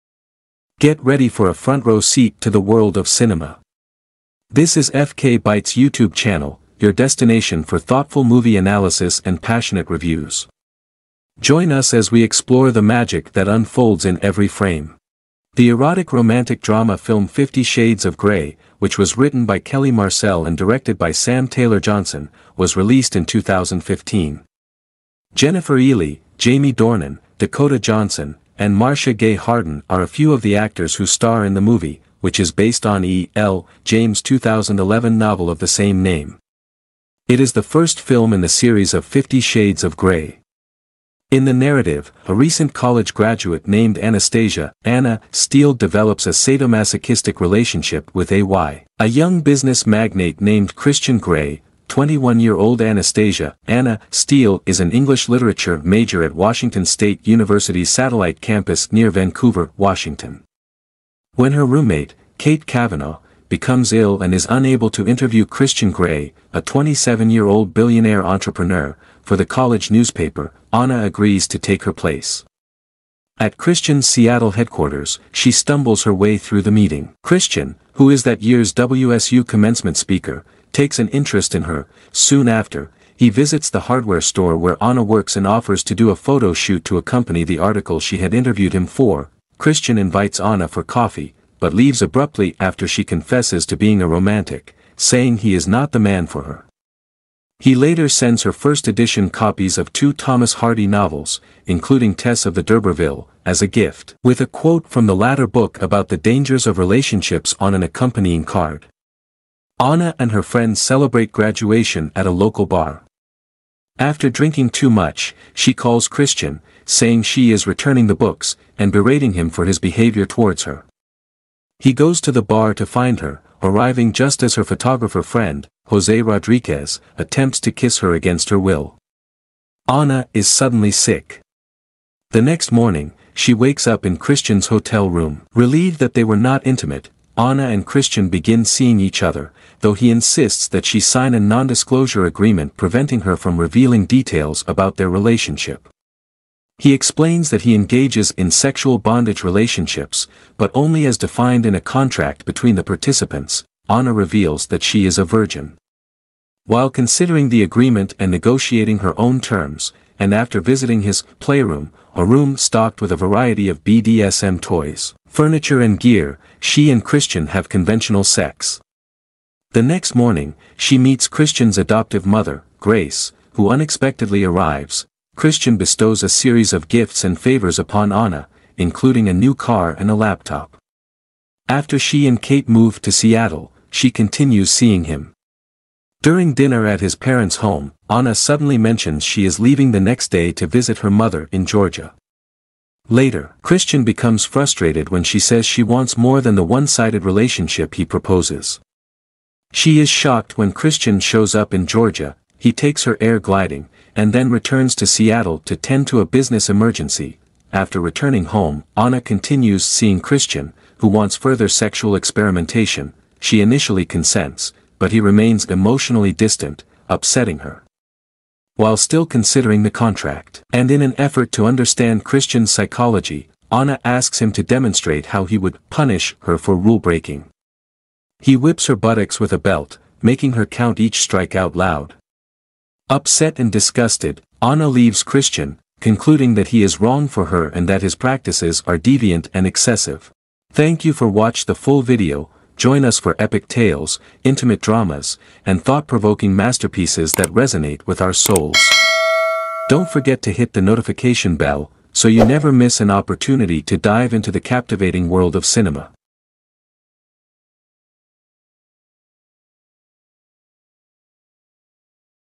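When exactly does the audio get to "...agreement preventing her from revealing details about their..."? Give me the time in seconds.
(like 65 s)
142 s.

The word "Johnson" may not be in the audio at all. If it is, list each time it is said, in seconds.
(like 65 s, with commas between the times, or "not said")
21 s, 27 s.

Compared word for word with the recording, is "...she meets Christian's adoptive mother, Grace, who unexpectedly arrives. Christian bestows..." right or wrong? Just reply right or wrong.
right.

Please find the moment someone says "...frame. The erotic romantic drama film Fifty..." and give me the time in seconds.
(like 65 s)
14 s.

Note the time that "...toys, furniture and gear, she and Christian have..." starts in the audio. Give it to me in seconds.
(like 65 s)
164 s.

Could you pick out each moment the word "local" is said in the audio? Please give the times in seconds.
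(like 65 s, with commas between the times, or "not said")
112 s.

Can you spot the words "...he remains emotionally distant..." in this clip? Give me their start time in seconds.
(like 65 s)
215 s.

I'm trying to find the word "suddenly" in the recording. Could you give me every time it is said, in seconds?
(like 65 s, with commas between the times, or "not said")
130 s, 188 s.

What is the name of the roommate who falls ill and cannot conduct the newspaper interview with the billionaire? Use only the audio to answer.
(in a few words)
Kate Kavanagh.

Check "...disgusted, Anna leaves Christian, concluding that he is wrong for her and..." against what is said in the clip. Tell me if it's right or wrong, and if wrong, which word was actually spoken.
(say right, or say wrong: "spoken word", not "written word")
right.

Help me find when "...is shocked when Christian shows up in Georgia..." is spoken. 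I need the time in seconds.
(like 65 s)
200 s.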